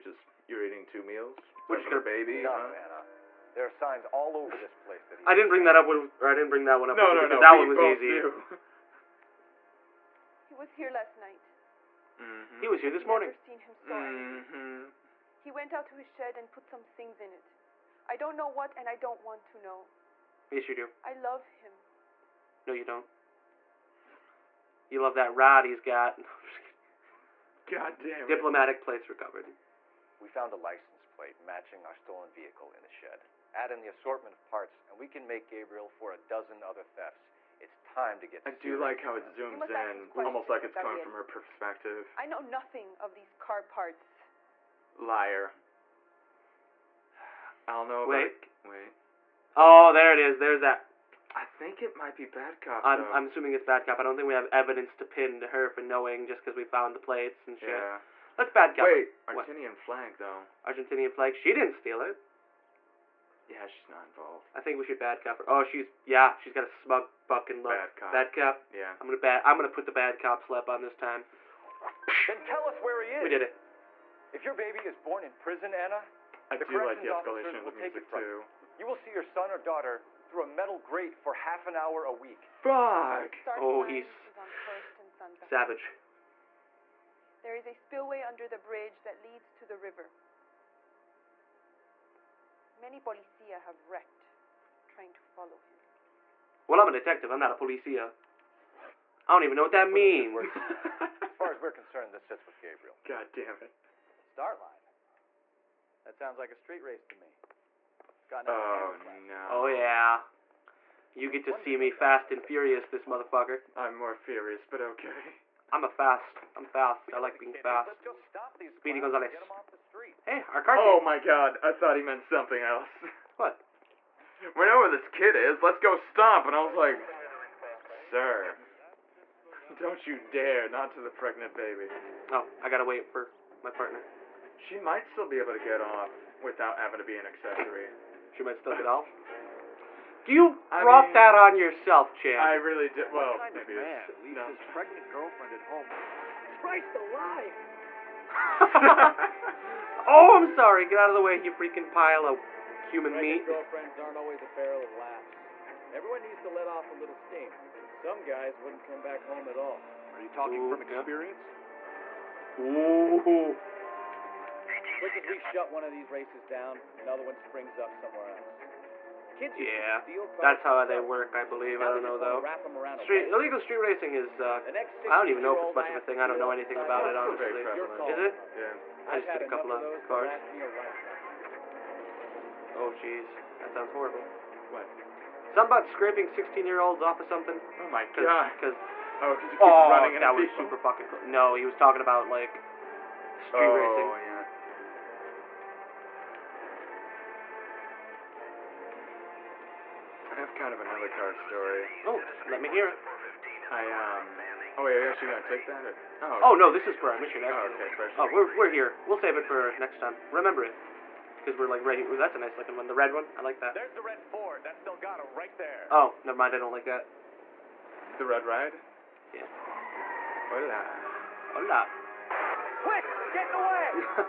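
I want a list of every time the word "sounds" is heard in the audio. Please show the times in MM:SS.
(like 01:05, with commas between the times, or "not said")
01:46, 03:03.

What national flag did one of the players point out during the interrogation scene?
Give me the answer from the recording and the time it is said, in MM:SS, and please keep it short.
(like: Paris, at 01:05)
Argentinian flag, at 01:00.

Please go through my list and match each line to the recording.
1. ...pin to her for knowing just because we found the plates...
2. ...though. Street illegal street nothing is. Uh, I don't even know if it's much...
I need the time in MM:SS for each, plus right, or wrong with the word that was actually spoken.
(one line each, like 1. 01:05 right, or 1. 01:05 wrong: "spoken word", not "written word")
1. 00:55 right
2. 02:52 wrong: "racing", not "nothing".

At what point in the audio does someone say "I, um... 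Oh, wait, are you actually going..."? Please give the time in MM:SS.
03:23.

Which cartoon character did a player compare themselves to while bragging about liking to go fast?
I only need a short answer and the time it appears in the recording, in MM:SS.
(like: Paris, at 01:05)
Speedy Gonzales, at 01:58.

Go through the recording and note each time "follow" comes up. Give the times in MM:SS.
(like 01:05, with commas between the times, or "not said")
01:35.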